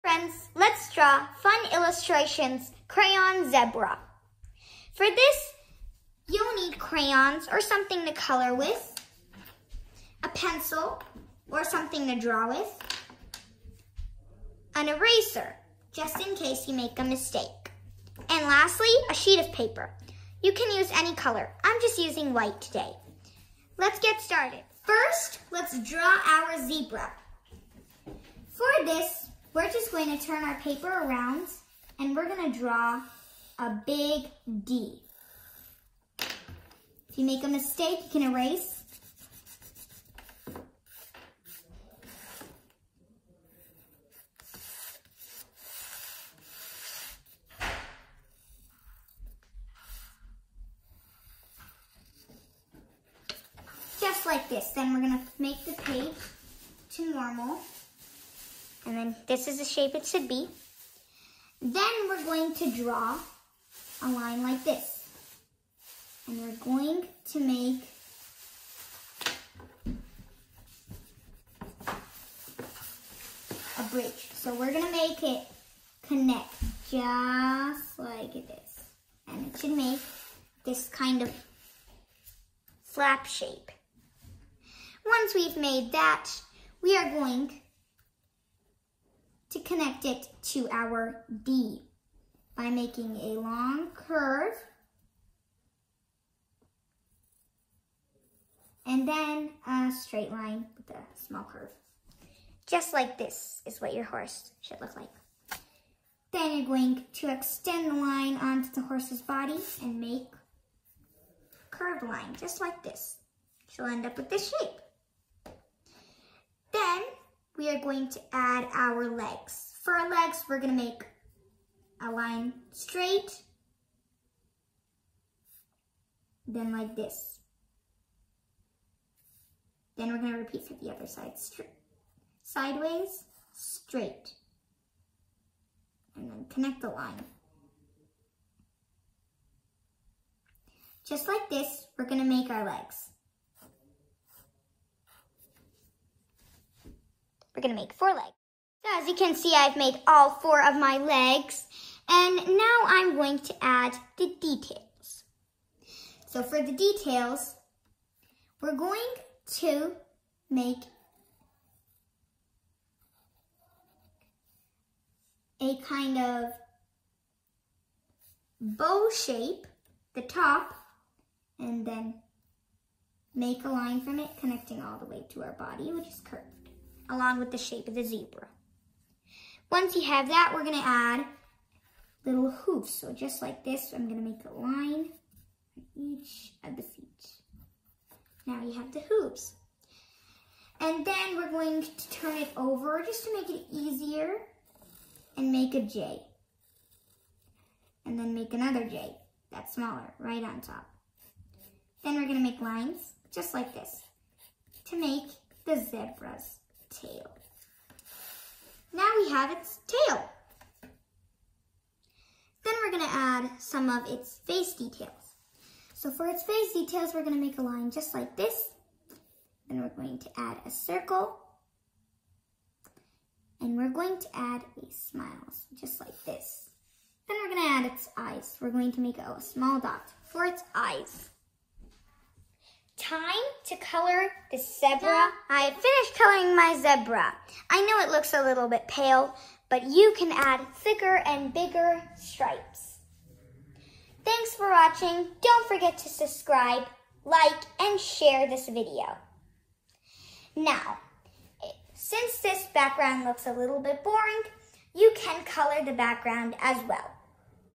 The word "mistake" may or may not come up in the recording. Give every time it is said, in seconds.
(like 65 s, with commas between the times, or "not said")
17 s, 37 s.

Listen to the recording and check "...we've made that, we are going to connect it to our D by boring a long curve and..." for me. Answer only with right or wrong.
wrong.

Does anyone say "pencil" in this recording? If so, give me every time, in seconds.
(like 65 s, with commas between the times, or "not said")
10 s.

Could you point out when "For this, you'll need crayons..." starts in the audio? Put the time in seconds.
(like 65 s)
4 s.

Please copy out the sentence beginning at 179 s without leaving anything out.
Once you have that, we're gonna add little hooves.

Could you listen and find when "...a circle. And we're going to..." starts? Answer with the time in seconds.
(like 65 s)
220 s.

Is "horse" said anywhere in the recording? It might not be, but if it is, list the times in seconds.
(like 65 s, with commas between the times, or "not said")
104 s, 108 s.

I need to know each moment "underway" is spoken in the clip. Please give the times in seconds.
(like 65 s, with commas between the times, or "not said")
not said.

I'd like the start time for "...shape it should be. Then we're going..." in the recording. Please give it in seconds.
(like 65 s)
59 s.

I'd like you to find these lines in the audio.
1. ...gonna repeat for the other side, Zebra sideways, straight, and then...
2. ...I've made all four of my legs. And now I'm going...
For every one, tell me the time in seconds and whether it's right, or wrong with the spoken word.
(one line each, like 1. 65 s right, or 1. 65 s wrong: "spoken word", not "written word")
1. 130 s wrong: "Stri", not "Zebra"
2. 149 s right.